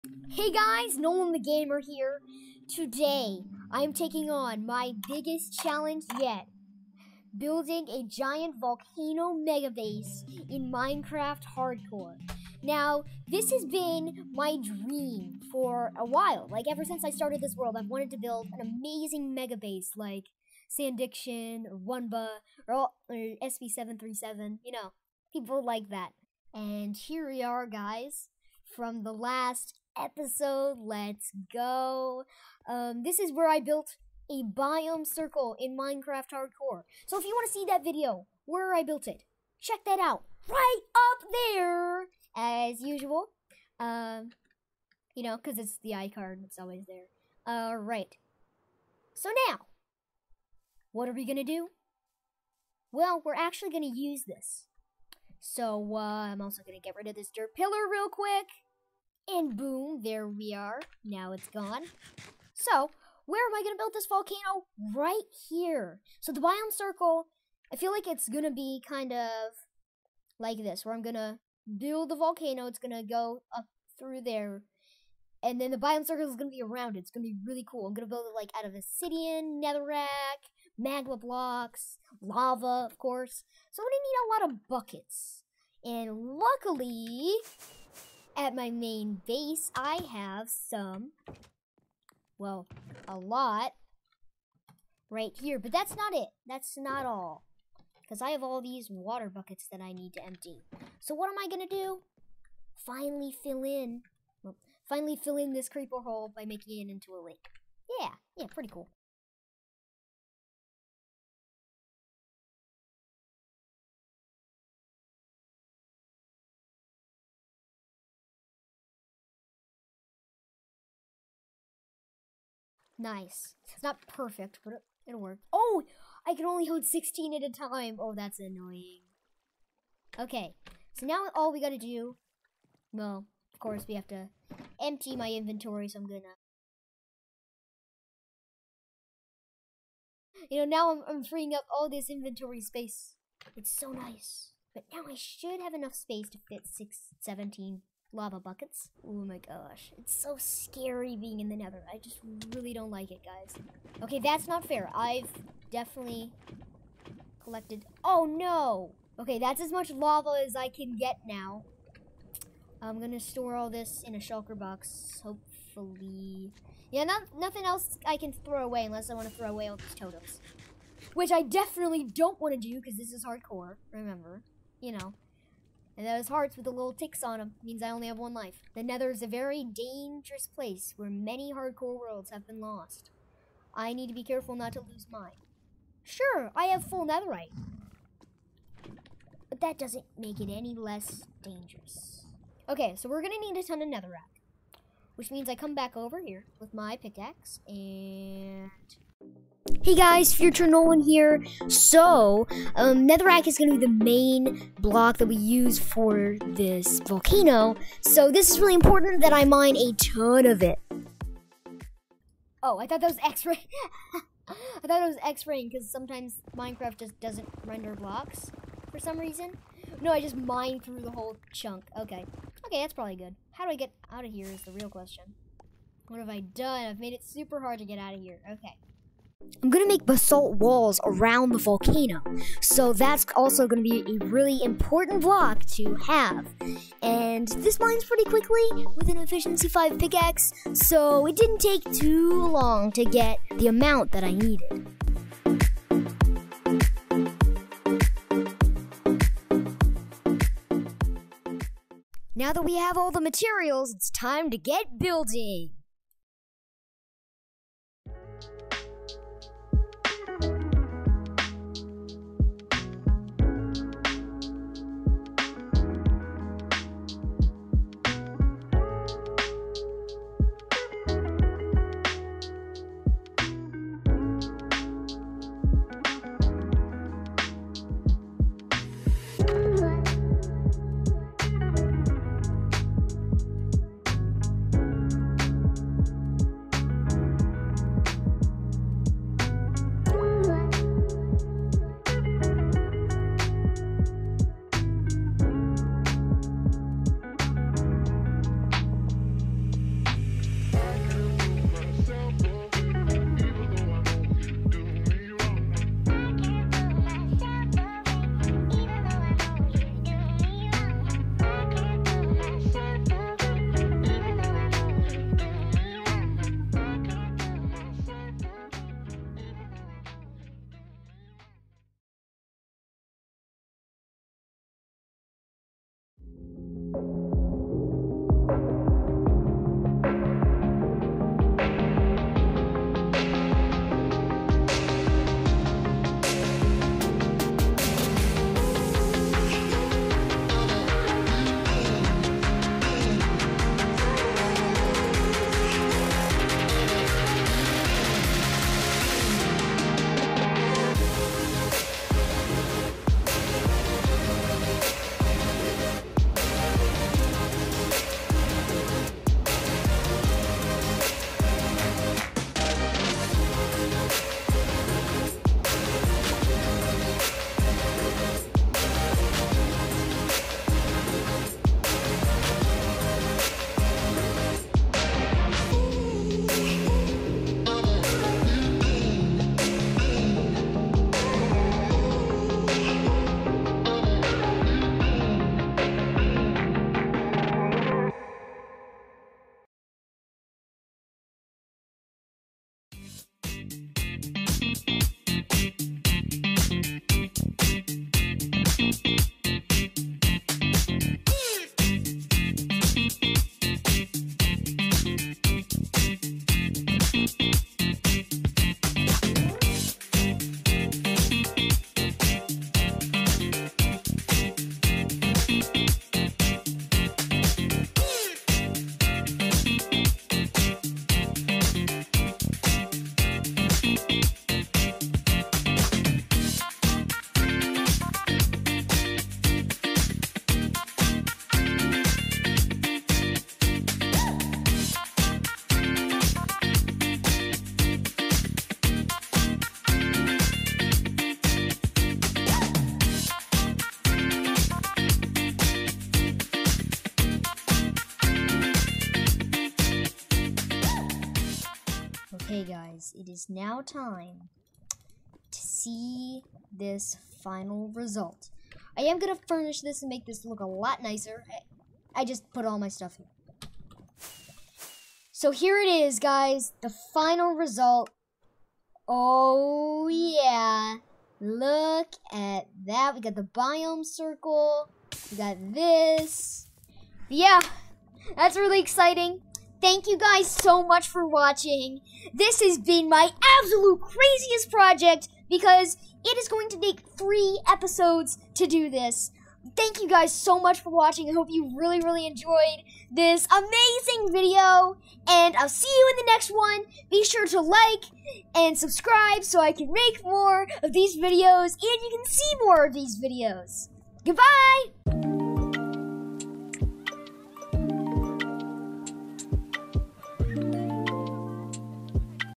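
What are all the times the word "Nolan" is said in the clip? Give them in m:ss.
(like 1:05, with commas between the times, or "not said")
0:00, 3:20.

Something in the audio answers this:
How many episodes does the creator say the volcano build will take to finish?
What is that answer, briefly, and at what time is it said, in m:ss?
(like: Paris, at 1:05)
3, at 8:07.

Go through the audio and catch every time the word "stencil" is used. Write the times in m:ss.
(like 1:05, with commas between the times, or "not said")
not said.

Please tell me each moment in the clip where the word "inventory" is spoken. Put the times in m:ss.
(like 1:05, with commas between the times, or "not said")
2:15, 2:22.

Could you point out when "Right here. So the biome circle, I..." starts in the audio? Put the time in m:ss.
1:04.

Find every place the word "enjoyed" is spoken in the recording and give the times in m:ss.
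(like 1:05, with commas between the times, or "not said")
8:12.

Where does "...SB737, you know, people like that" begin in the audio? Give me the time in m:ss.
0:23.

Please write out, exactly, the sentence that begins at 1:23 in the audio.
So I'm going to need a lot of buckets.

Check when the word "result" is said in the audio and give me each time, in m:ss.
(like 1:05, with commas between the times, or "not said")
7:37, 7:47.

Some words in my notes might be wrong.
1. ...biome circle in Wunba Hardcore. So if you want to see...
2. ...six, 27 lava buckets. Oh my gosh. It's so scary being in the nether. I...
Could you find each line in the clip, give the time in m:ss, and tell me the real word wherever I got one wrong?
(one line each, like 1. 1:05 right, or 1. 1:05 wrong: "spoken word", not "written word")
1. 0:34 wrong: "Minecraft", not "Wunba"
2. 2:26 wrong: "17", not "27".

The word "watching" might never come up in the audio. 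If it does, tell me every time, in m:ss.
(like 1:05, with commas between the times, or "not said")
8:01, 8:10.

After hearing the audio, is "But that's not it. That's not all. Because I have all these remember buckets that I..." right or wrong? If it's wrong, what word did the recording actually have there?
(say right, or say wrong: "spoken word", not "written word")
wrong: "water", not "remember".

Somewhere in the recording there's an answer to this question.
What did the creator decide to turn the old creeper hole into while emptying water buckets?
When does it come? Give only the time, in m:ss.
1:47.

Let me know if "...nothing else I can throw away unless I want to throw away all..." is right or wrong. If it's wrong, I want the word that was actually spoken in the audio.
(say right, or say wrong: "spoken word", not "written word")
right.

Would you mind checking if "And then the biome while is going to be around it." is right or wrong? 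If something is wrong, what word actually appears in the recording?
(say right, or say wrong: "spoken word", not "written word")
wrong: "circle", not "while".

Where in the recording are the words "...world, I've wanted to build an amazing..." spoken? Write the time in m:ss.
0:17.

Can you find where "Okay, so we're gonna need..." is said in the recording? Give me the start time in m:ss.
3:12.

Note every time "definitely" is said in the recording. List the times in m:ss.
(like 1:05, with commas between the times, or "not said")
2:35, 2:51.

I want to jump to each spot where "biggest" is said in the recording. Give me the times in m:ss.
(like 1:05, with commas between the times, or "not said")
0:05.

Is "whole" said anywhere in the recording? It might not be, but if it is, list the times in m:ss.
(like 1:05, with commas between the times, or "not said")
3:41.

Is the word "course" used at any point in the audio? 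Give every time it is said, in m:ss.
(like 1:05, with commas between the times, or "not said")
1:22, 2:13.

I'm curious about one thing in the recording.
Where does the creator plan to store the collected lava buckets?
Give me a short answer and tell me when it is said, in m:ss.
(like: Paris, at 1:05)
A shulker box, at 2:44.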